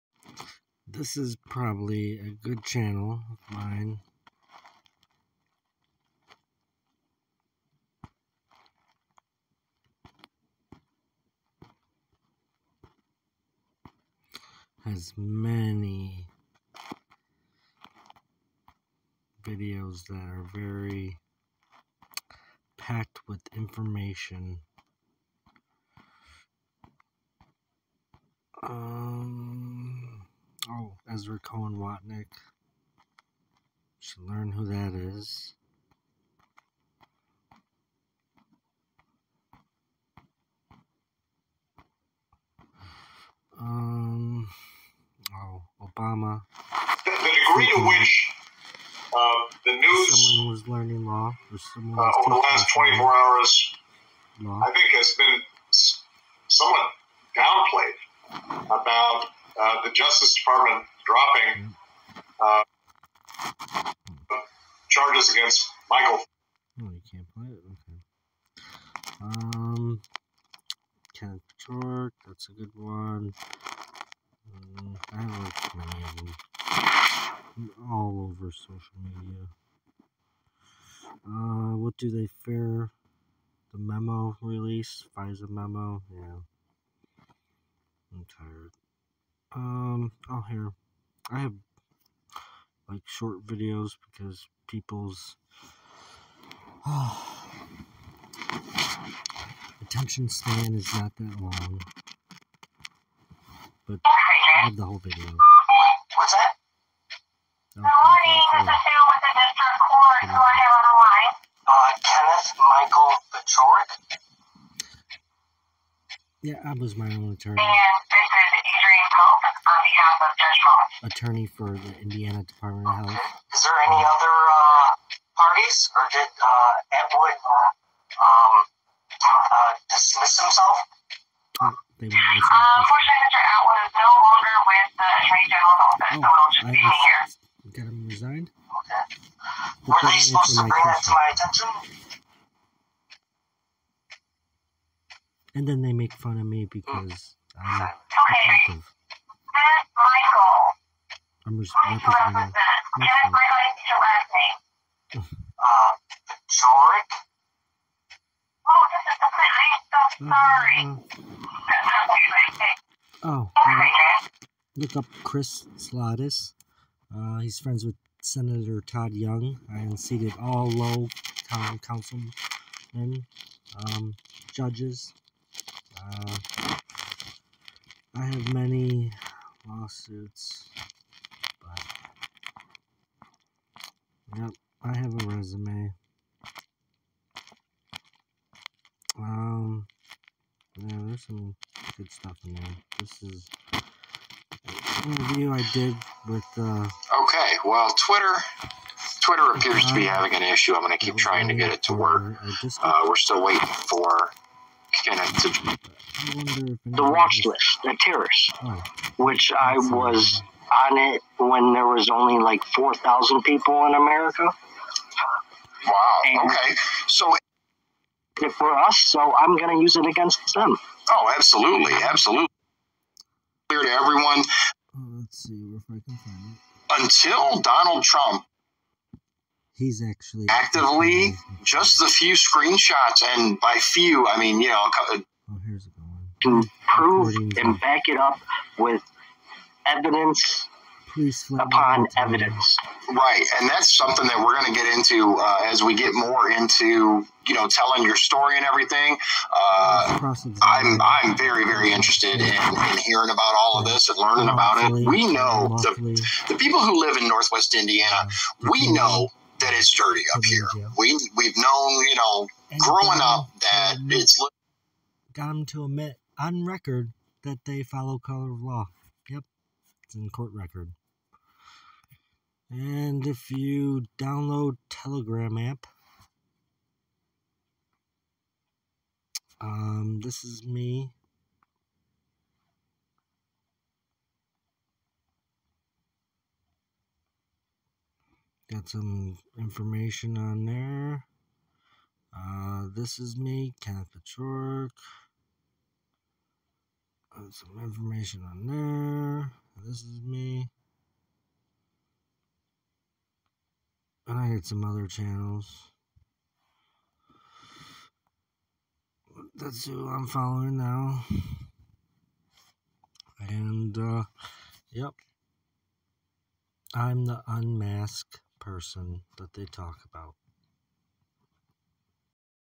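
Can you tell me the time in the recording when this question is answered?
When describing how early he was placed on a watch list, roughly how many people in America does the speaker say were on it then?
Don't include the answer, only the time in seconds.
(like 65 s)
212 s.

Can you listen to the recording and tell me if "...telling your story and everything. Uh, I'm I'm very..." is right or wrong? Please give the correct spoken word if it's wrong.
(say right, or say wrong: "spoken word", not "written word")
right.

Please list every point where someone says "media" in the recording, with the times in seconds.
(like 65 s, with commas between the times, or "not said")
79 s.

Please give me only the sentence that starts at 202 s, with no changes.
Uh, we're still waiting for The watch list, the terrace, oh.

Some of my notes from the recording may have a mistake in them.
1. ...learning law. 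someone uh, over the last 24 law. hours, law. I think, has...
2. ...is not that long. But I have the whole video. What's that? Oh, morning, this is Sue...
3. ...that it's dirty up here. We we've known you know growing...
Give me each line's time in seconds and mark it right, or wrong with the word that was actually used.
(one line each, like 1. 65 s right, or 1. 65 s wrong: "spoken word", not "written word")
1. 50 s right
2. 100 s right
3. 259 s right.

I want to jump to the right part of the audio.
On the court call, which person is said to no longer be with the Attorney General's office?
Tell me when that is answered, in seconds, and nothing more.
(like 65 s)
133 s.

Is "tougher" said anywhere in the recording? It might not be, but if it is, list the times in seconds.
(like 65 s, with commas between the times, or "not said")
not said.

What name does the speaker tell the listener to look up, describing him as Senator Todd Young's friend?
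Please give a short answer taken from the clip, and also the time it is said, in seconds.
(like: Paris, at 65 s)
Chris Slatis, at 165 s.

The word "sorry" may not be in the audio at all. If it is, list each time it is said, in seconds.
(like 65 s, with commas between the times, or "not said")
161 s.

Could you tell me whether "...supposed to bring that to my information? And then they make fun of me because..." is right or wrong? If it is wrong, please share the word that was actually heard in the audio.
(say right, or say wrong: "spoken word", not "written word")
wrong: "attention", not "information".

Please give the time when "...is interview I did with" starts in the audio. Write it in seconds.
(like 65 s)
193 s.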